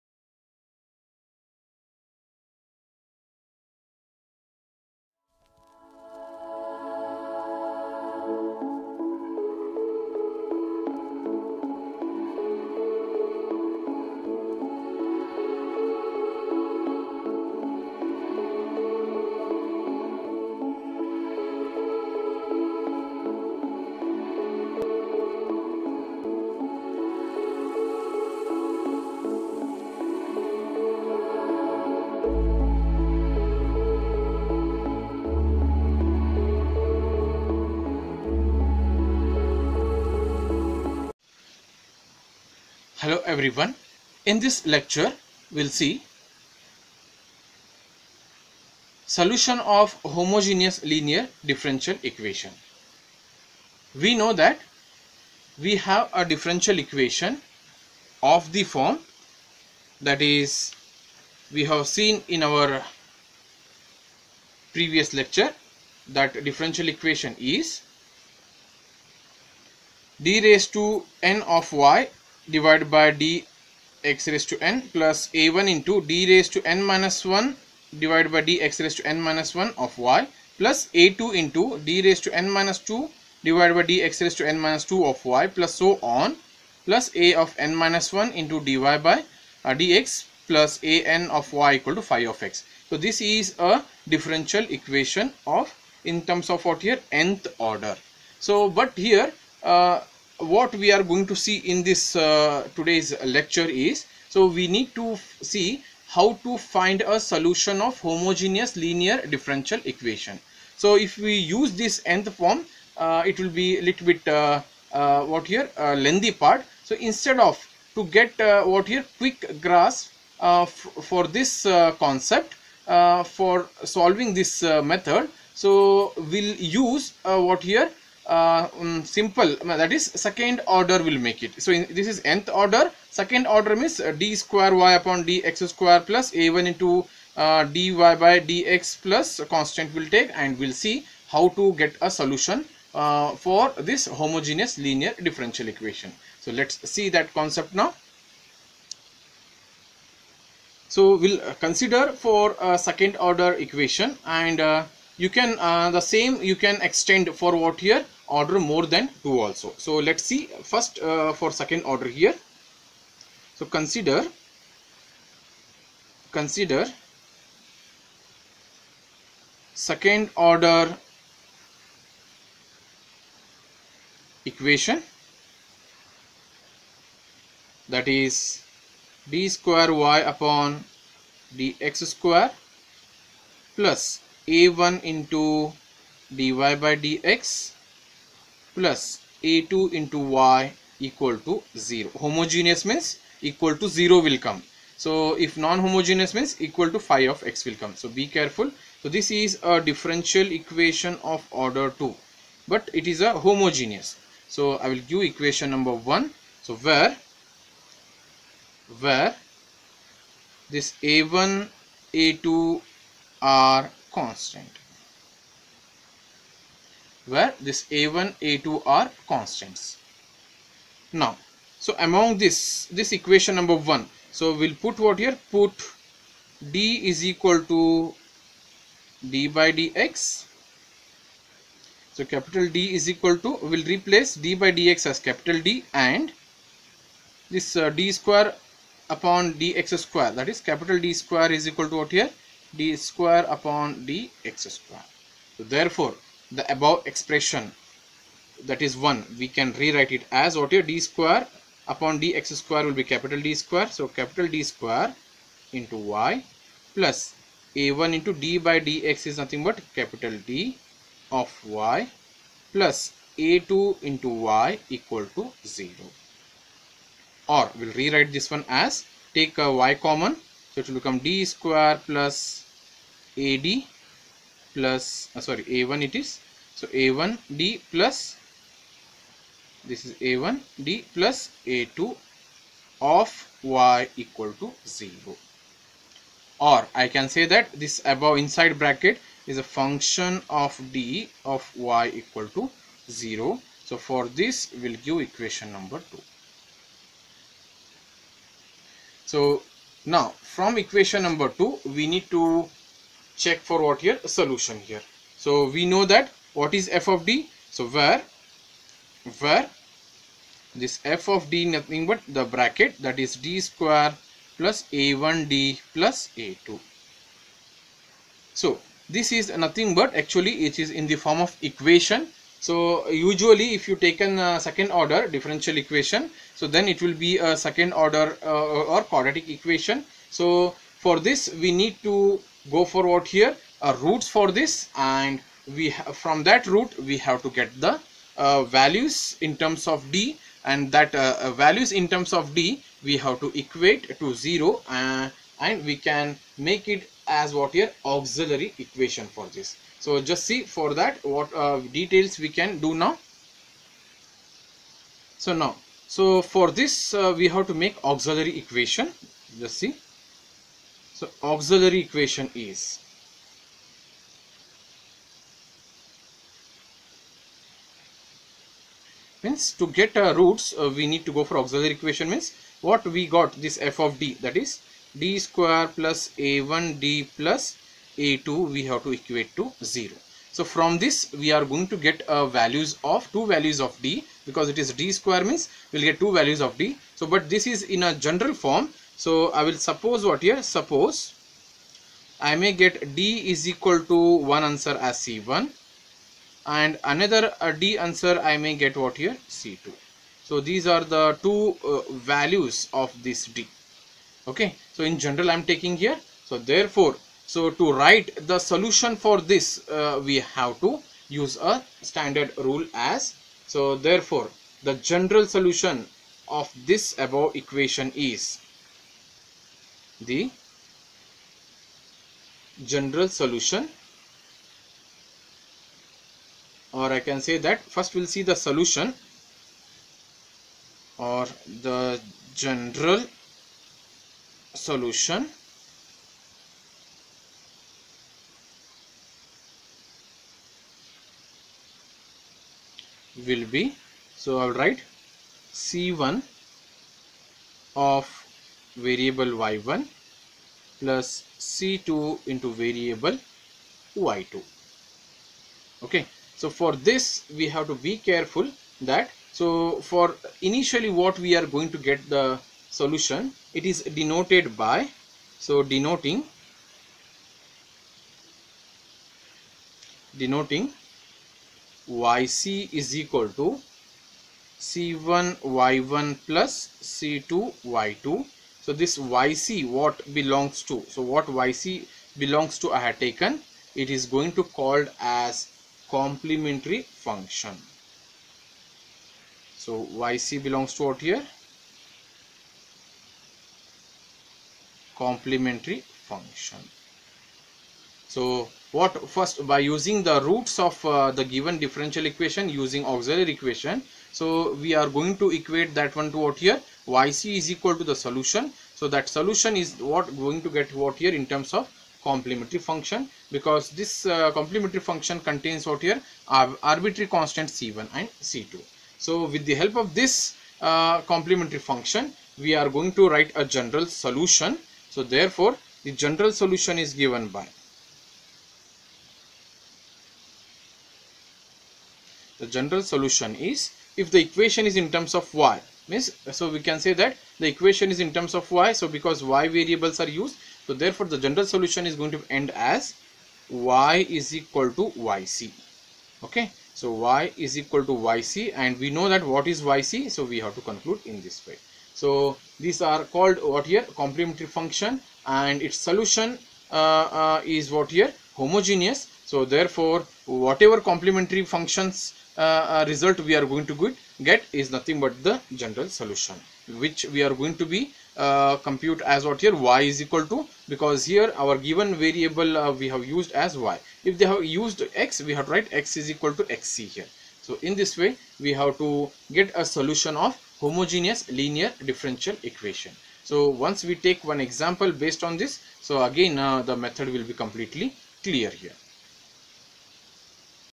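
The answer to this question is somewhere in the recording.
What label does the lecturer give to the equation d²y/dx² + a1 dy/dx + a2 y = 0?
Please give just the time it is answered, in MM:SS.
03:25.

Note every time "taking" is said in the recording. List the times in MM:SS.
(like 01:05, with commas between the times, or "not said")
06:45.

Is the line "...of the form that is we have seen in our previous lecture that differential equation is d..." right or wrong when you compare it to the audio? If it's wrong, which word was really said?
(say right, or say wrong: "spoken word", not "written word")
right.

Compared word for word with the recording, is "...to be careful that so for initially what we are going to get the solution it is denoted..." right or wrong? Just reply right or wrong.
right.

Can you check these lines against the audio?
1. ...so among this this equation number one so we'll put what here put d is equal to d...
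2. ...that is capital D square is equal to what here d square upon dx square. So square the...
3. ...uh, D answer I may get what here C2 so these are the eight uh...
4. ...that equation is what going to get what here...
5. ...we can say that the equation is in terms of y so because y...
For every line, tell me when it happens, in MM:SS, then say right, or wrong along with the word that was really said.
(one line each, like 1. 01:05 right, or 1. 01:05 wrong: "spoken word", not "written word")
1. 03:41 right
2. 04:00 wrong: "therefore", not "square"
3. 06:37 wrong: "two", not "eight"
4. 08:29 wrong: "solution", not "equation"
5. 08:56 right.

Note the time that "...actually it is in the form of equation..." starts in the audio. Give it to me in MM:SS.
05:20.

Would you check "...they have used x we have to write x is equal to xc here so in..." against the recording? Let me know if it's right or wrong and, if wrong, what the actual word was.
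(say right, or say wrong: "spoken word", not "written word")
right.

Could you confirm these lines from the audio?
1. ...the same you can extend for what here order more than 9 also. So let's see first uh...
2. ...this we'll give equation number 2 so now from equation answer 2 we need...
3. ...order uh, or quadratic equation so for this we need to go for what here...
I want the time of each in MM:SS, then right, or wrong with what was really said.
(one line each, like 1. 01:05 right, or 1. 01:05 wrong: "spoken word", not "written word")
1. 02:35 wrong: "2", not "9"
2. 04:54 wrong: "number", not "answer"
3. 05:28 right.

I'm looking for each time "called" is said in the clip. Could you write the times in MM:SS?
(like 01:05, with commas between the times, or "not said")
08:04, 09:13.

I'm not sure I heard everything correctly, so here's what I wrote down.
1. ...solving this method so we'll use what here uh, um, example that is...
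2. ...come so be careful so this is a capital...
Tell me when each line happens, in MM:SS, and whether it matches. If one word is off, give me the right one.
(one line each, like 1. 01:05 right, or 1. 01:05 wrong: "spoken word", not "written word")
1. 02:03 wrong: "simple", not "example"
2. 03:17 wrong: "differential", not "capital".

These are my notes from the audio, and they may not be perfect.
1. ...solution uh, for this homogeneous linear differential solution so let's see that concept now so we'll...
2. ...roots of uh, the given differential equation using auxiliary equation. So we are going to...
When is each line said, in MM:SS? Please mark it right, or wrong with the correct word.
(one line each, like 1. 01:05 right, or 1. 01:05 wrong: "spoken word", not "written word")
1. 02:22 wrong: "equation", not "solution"
2. 08:20 right.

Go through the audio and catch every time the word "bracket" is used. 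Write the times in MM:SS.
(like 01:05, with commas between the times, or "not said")
04:48, 05:12.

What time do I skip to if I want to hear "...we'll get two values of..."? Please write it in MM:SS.
06:25.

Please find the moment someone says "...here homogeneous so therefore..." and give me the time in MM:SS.
09:18.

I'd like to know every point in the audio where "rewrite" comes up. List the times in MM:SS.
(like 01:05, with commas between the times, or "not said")
04:09, 04:28.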